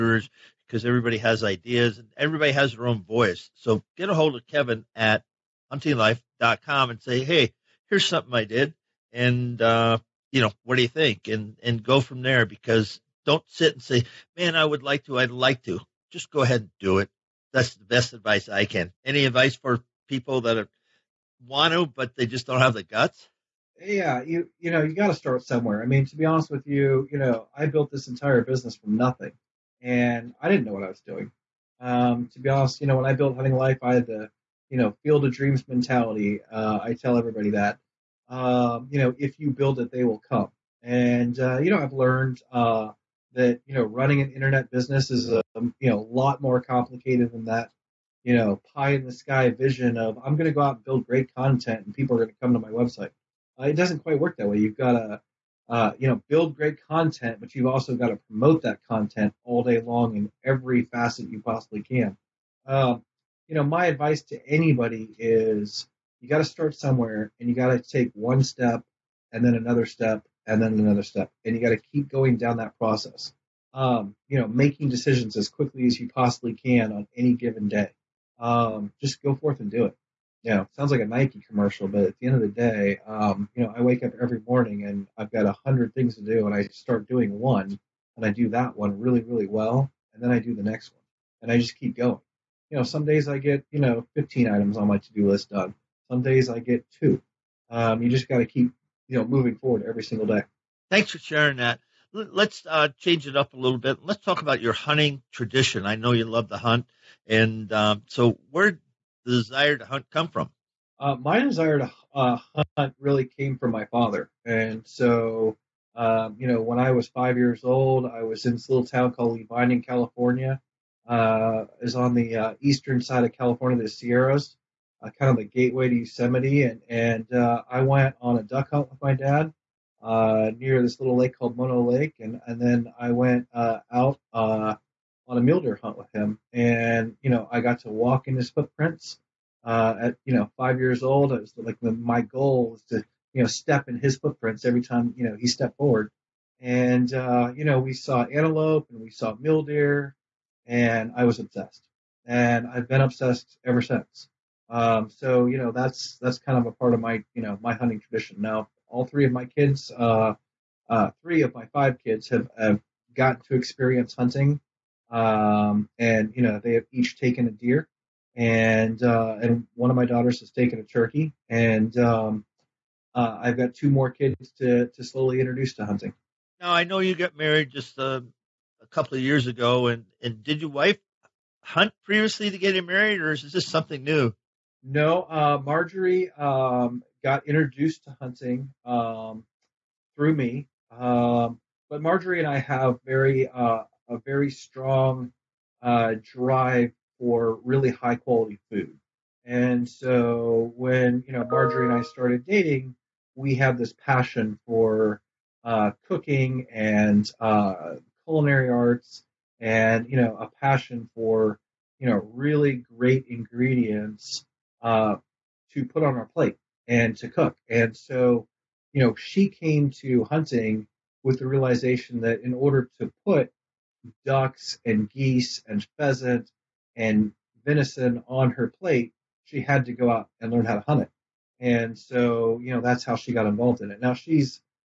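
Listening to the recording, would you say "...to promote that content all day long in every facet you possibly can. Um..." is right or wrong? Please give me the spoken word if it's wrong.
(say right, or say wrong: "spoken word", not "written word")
right.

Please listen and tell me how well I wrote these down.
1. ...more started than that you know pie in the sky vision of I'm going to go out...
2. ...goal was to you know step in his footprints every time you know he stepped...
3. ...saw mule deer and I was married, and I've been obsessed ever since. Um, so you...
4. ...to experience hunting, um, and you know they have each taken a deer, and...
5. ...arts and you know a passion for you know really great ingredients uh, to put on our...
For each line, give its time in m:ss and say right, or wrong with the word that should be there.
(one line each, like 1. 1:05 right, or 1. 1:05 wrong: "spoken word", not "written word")
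1. 0:46 wrong: "complicated", not "started"
2. 2:22 right
3. 2:29 wrong: "obsessed", not "married"
4. 2:43 right
5. 3:28 right.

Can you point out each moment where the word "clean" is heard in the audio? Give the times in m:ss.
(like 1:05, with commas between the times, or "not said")
not said.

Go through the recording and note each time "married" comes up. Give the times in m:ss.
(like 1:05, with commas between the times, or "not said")
2:57, 3:02.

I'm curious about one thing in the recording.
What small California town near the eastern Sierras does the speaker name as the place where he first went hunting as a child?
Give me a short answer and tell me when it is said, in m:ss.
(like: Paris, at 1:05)
Lee Vining, at 1:59.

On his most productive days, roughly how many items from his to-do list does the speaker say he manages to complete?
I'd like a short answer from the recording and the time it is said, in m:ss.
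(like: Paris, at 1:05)
15, at 1:34.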